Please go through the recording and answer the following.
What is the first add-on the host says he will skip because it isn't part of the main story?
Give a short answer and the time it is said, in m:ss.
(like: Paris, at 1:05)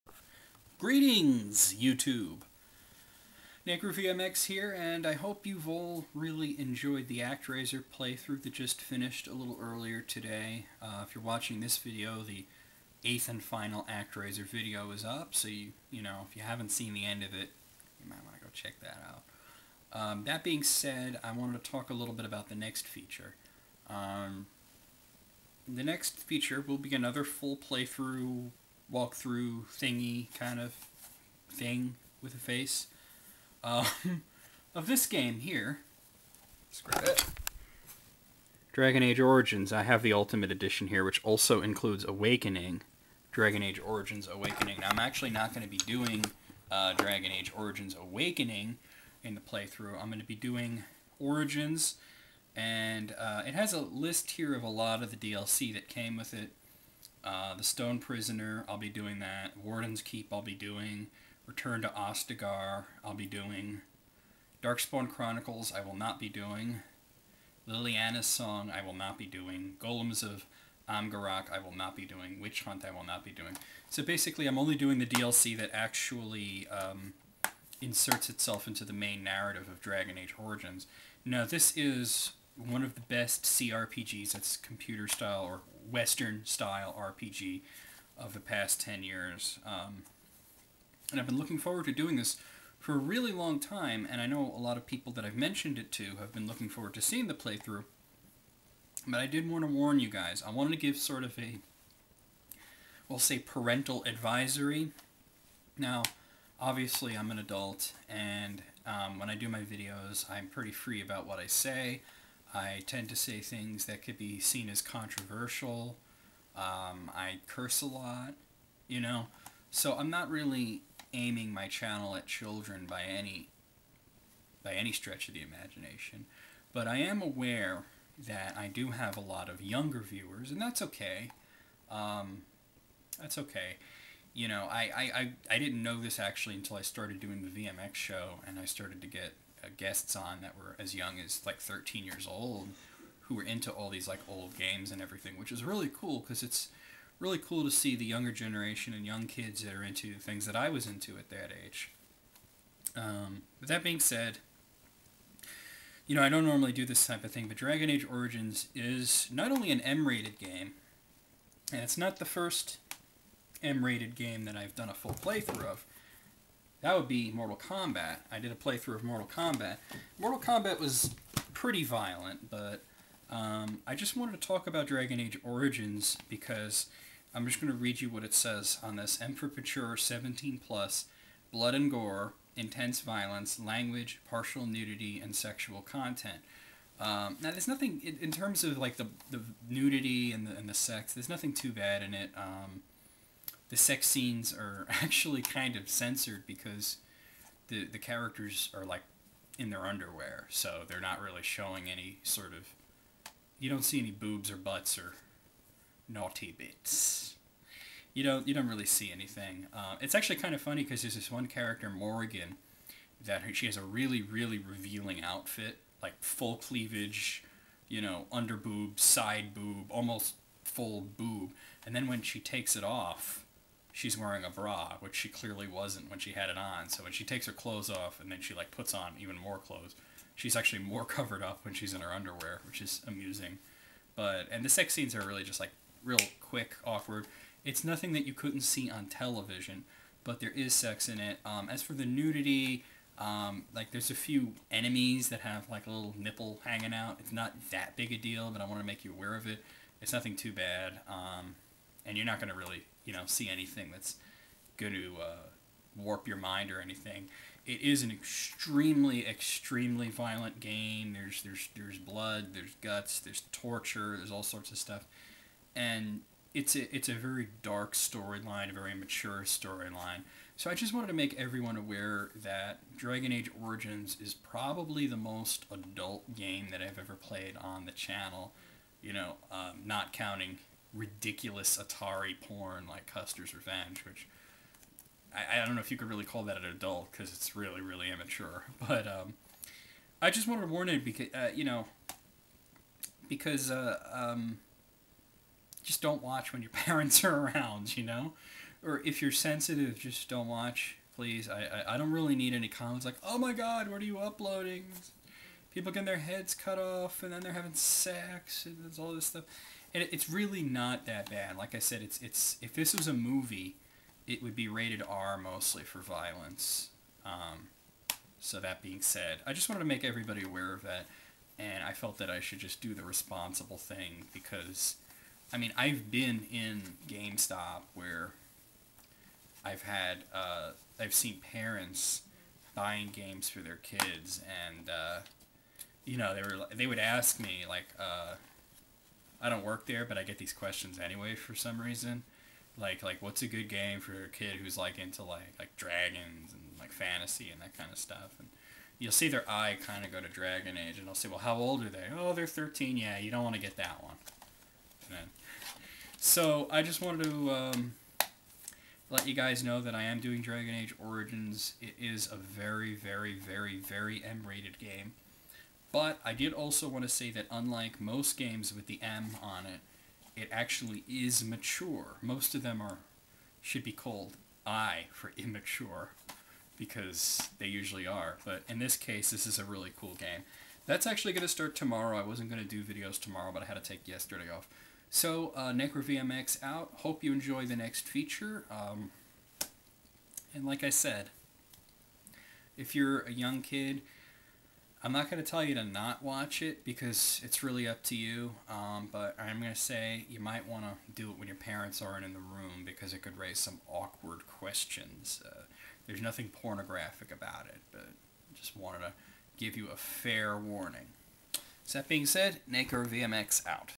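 Darkspawn Chronicles, at 1:04.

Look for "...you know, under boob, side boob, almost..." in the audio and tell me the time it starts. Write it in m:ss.
3:37.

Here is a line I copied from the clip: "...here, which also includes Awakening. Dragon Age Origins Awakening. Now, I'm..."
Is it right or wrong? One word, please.
right.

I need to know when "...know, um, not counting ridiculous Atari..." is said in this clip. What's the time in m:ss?
4:39.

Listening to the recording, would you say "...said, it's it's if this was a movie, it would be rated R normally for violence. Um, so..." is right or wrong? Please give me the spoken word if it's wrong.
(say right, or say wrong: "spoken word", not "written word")
wrong: "mostly", not "normally".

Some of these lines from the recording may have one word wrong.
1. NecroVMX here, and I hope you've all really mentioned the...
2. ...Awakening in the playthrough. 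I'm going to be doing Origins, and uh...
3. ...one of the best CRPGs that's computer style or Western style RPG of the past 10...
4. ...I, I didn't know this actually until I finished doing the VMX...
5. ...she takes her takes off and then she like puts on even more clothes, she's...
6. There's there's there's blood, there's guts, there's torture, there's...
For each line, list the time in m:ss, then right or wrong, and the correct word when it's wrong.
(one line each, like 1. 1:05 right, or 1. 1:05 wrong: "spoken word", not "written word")
1. 0:03 wrong: "enjoyed", not "mentioned"
2. 0:48 right
3. 1:22 right
4. 2:15 wrong: "started", not "finished"
5. 3:47 wrong: "clothes", not "takes"
6. 4:21 right.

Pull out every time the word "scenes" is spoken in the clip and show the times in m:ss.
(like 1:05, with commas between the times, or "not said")
3:14, 3:54.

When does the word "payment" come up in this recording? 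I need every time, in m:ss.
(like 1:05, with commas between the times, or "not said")
not said.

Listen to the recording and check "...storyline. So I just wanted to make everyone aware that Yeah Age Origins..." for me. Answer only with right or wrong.
wrong.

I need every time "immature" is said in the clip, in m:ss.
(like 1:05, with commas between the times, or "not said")
4:48, 6:15.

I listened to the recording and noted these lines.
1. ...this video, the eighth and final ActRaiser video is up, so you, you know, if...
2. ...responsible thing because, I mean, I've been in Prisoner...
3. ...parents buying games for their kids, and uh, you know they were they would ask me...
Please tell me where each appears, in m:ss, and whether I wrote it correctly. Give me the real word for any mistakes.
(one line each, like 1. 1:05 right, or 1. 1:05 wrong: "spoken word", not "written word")
1. 0:11 right
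2. 5:23 wrong: "GameStop", not "Prisoner"
3. 5:31 right.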